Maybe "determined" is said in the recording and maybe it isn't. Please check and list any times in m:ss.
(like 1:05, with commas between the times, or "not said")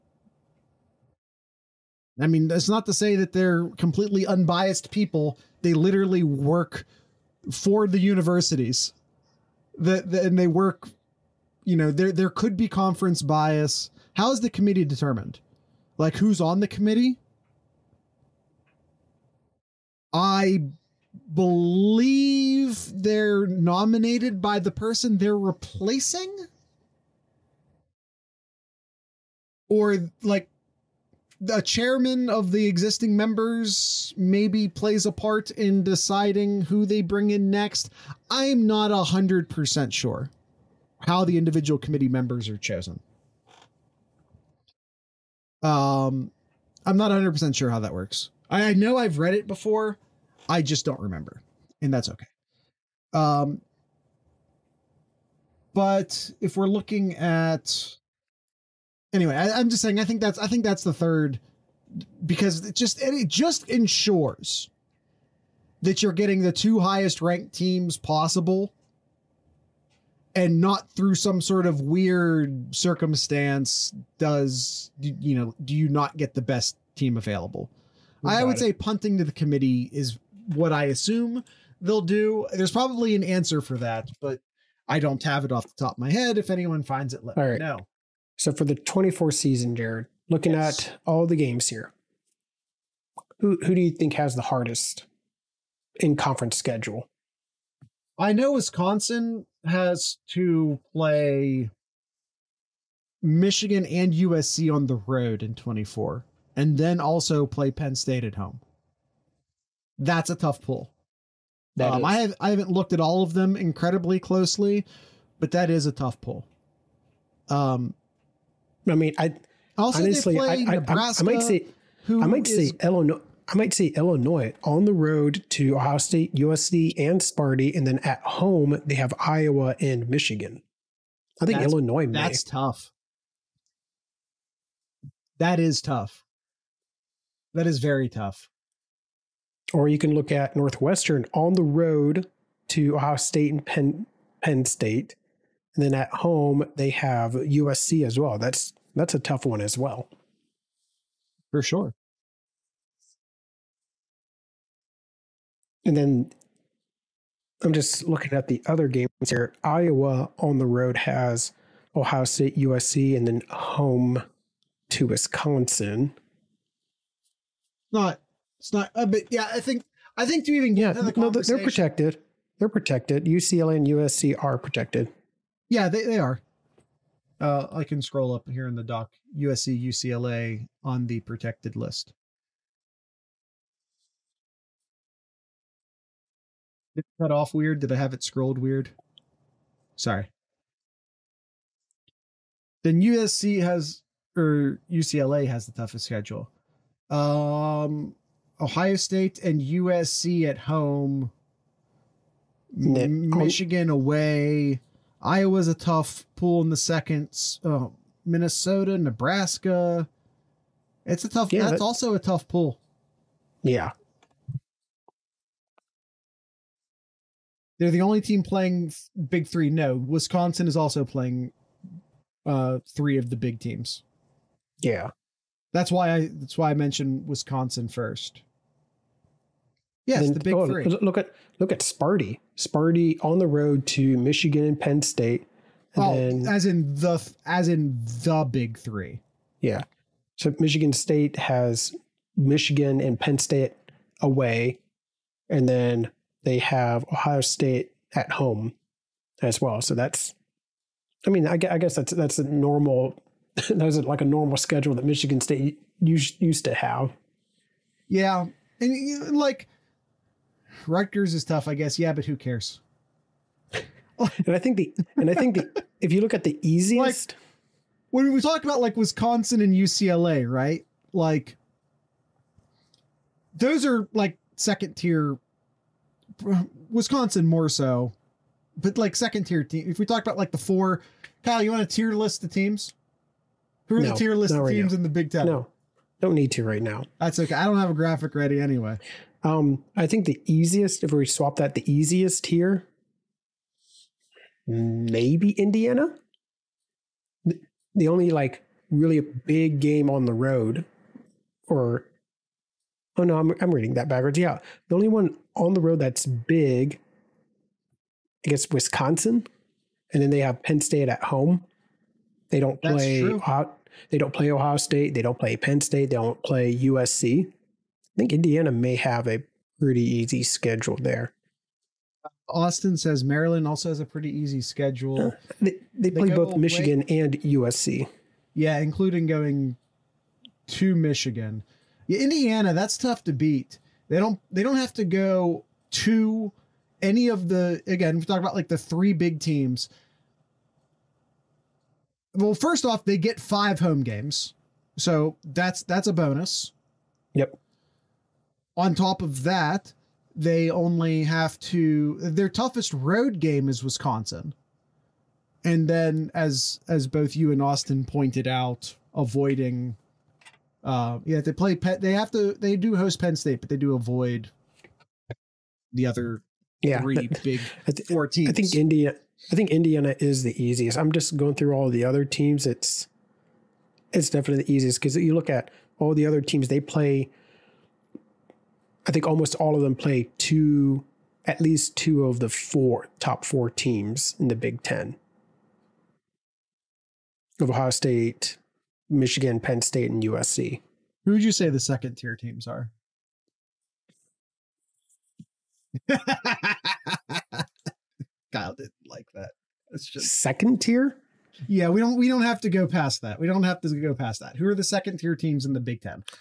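0:14.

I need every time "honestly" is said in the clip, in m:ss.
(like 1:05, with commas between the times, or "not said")
2:00.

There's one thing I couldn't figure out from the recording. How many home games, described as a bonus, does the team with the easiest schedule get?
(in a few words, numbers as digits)
5.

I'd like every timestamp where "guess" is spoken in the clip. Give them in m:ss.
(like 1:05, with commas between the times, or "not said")
4:11, 4:21, 5:08.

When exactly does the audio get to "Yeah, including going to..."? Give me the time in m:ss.
5:28.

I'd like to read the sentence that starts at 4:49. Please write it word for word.
Um, I think the easiest, if we swap that, the easiest here, maybe Indiana.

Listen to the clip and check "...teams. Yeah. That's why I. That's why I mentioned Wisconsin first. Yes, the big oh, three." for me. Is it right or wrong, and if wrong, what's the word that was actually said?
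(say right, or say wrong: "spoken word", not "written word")
right.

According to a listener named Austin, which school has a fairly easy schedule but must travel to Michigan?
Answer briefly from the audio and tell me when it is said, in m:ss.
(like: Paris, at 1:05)
Maryland, at 5:23.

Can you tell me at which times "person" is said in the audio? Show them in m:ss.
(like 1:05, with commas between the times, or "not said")
0:24.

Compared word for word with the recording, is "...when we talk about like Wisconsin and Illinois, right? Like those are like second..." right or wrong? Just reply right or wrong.
wrong.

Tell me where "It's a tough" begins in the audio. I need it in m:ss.
3:31.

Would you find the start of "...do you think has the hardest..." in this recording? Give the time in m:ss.
1:33.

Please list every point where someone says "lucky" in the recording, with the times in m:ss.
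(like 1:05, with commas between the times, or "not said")
not said.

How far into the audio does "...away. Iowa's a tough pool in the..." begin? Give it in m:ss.
3:23.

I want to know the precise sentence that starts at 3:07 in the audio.
Did I have it scrolled weird?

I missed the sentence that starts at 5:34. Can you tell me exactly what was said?
They don't they don't have to go to any of the again, we talk about like the three big teams.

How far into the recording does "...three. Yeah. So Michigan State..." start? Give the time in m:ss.
3:58.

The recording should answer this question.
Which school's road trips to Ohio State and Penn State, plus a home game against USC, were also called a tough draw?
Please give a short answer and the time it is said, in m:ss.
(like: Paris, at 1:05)
Northwestern, at 2:20.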